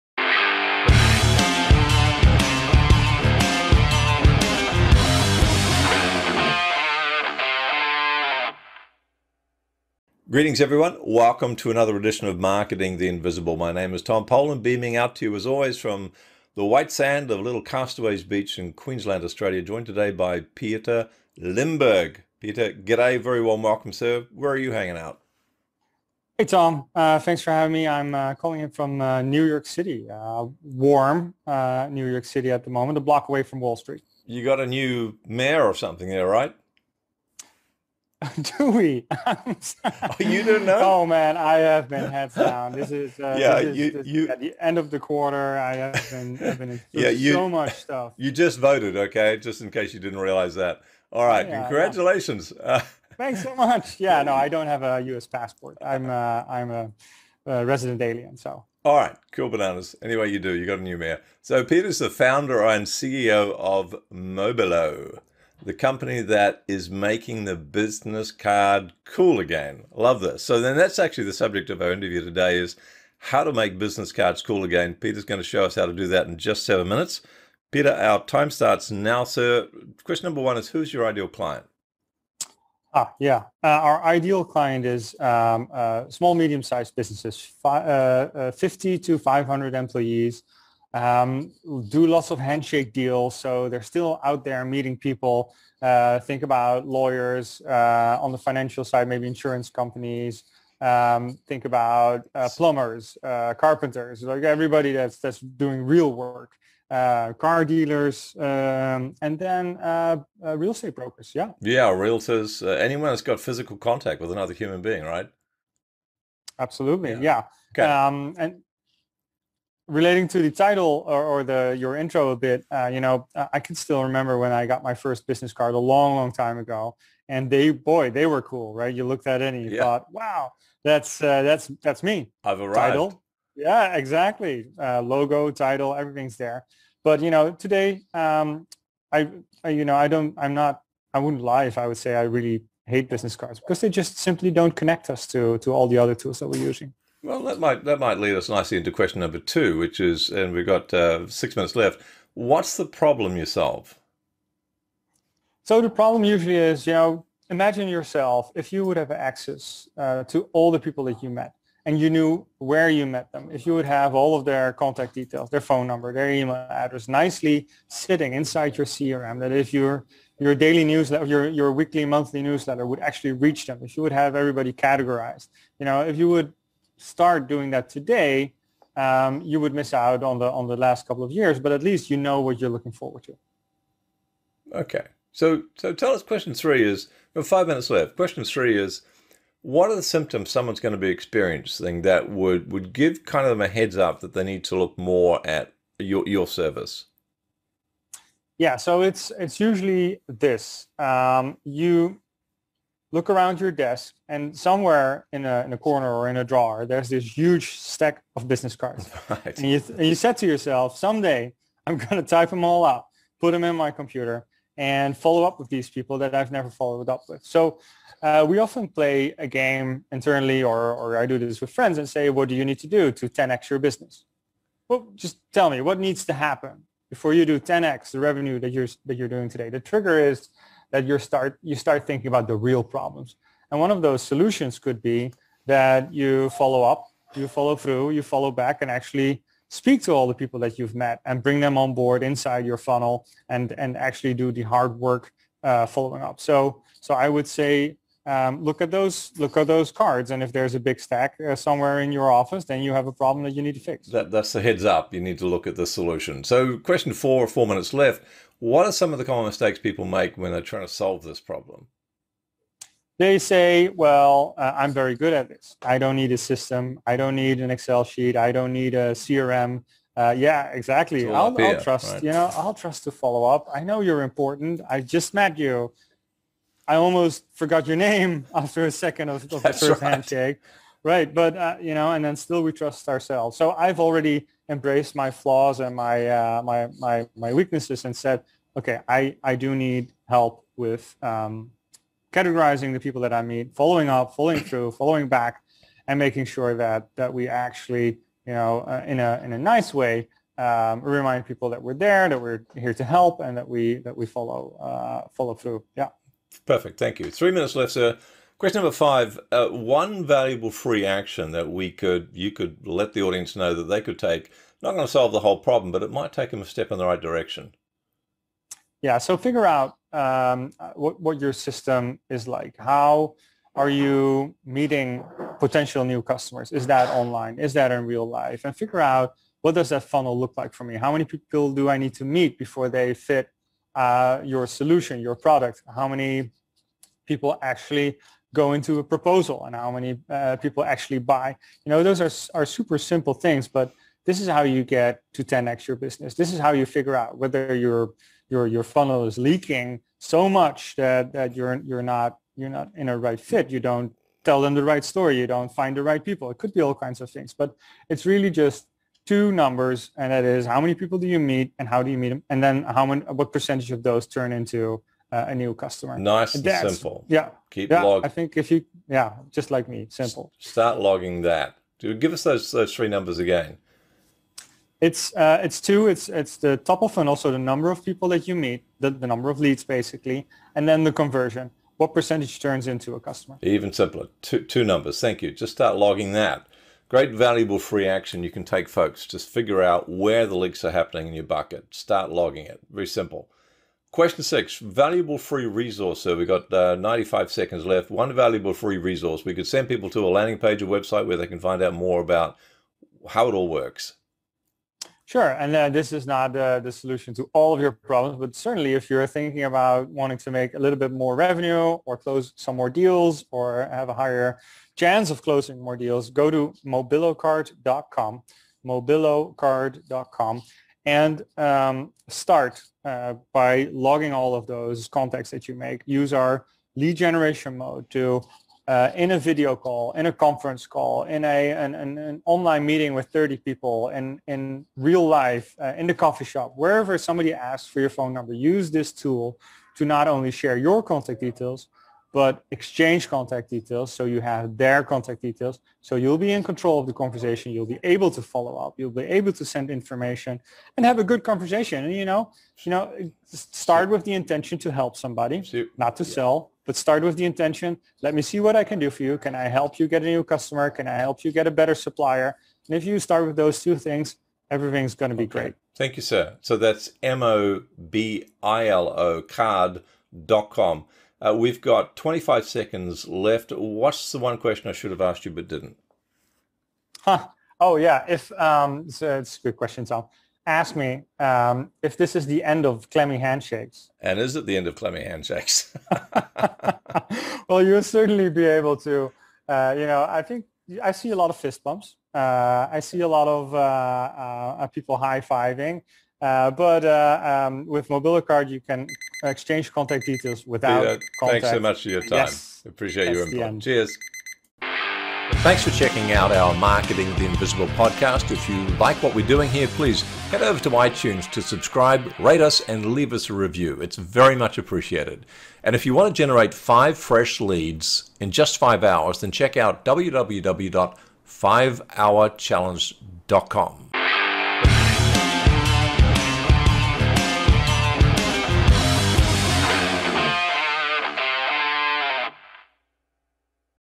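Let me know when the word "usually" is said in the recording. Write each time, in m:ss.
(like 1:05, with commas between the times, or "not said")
2:36, 3:19.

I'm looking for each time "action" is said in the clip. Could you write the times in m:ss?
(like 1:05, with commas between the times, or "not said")
5:11, 6:28.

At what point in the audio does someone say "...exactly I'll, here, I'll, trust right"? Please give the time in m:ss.
4:30.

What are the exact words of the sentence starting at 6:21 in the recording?
What percentage turns into a customer?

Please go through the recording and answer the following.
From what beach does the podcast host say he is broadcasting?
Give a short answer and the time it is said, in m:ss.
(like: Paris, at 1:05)
Little Castaways Beach, at 0:17.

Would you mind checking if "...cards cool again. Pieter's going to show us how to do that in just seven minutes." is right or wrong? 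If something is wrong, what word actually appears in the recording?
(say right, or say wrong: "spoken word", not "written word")
right.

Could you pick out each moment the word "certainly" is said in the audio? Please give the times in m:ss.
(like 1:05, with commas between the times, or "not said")
6:48, 8:08.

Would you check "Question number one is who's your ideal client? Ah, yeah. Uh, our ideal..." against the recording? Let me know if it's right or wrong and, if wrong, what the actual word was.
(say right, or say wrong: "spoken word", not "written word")
right.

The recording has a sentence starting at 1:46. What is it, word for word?
Uh, car dealers um, and then uh, real estate brokers.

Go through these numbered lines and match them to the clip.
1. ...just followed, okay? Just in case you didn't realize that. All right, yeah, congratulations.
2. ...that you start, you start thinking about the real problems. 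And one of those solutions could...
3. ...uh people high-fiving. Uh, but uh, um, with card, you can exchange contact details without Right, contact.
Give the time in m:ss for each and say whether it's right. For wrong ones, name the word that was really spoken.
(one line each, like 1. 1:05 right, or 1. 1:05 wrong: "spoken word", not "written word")
1. 0:48 wrong: "voted", not "followed"
2. 3:50 right
3. 8:14 wrong: "Pieter", not "Right".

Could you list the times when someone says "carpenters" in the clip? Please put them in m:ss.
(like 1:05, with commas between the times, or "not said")
1:43.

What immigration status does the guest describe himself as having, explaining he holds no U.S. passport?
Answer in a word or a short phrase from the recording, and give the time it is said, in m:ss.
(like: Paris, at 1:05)
resident alien, at 0:57.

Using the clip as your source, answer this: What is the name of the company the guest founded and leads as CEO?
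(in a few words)
Mobilo.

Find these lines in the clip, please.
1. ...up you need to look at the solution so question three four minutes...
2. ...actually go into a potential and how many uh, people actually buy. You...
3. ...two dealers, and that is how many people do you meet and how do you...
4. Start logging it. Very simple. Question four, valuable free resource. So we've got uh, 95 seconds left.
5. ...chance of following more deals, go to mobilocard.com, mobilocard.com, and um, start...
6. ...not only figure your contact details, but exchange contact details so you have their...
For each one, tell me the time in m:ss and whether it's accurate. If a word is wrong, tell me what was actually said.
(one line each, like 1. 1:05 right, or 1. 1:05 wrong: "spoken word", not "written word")
1. 4:14 wrong: "four", not "three"
2. 5:37 wrong: "proposal", not "potential"
3. 5:59 wrong: "numbers", not "dealers"
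4. 6:31 wrong: "six", not "four"
5. 6:54 wrong: "closing", not "following"
6. 7:20 wrong: "share", not "figure".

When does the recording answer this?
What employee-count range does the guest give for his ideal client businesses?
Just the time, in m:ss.
1:28.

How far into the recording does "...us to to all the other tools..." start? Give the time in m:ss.
2:25.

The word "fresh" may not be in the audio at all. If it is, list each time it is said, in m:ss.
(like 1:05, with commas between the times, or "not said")
8:37.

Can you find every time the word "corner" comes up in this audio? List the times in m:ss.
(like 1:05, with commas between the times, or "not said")
3:25.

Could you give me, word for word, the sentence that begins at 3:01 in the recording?
But at least you know what you're looking forward to.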